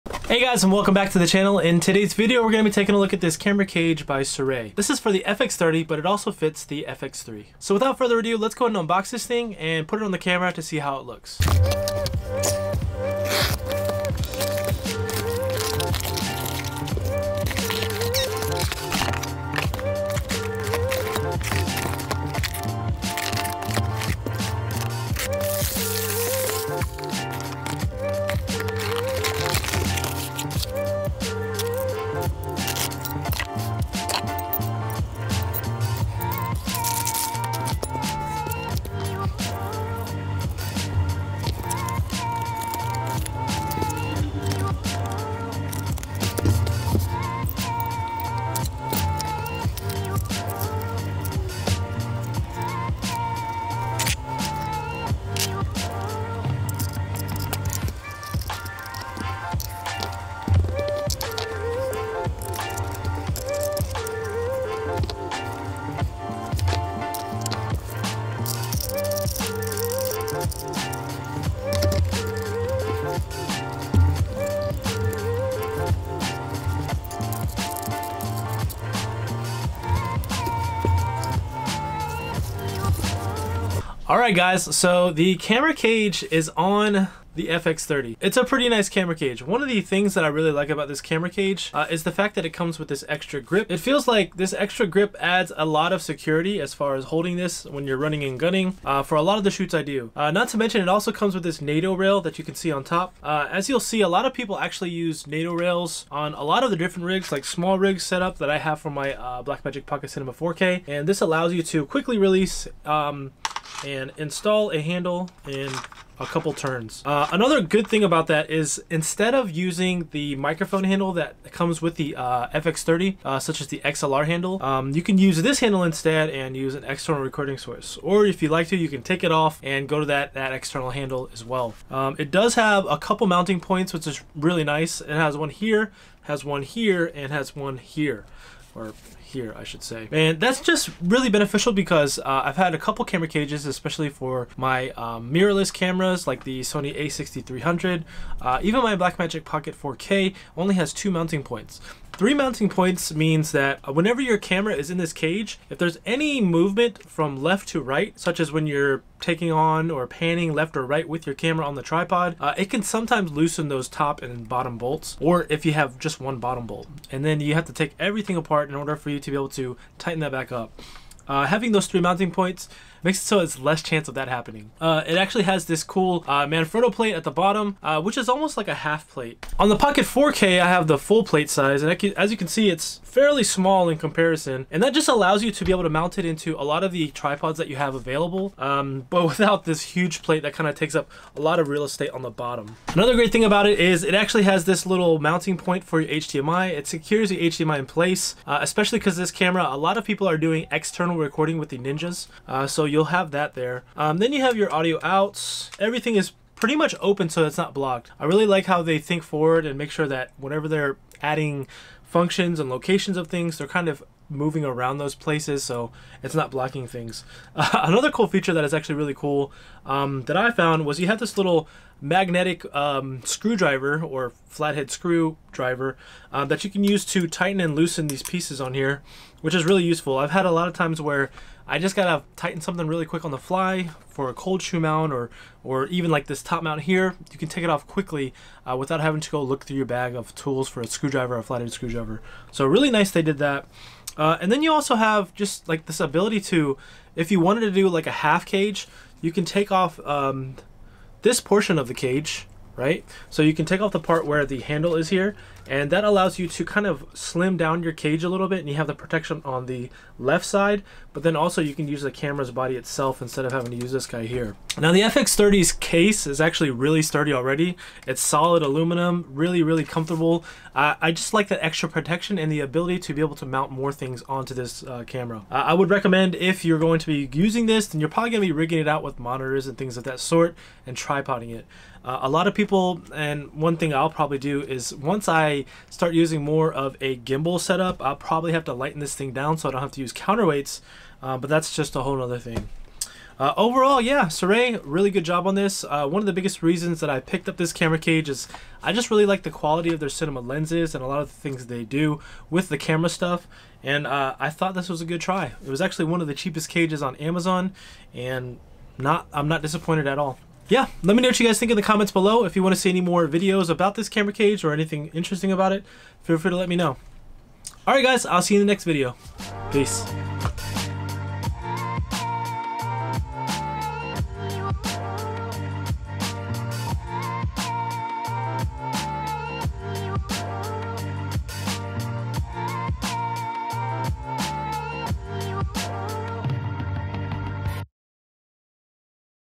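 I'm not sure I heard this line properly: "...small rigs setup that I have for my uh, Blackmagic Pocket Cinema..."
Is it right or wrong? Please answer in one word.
right.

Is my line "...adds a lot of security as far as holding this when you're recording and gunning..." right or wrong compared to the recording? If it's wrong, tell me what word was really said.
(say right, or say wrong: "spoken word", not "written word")
wrong: "running", not "recording".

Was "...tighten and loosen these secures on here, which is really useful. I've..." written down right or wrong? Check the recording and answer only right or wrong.
wrong.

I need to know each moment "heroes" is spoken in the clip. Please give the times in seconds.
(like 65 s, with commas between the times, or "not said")
not said.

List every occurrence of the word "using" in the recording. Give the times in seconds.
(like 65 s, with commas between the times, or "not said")
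119 s, 277 s, 286 s.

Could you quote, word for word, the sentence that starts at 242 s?
So really nice they did that.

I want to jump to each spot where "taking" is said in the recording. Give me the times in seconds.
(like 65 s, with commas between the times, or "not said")
2 s, 159 s.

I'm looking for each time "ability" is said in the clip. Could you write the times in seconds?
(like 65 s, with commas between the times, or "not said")
245 s, 272 s.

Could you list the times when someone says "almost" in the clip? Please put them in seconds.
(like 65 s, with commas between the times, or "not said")
178 s.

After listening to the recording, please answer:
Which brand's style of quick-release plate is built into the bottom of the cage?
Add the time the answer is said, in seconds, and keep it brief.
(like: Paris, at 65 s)
Manfrotto, at 176 s.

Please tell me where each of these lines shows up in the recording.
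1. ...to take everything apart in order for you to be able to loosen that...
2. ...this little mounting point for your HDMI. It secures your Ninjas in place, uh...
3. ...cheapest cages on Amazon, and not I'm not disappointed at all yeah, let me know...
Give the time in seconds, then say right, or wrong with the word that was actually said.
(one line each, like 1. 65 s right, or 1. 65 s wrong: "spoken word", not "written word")
1. 167 s wrong: "tighten", not "loosen"
2. 194 s wrong: "HDMI", not "Ninjas"
3. 306 s right.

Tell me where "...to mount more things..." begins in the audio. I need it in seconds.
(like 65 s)
273 s.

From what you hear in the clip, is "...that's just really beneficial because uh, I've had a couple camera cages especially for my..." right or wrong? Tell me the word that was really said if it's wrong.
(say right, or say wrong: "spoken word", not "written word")
right.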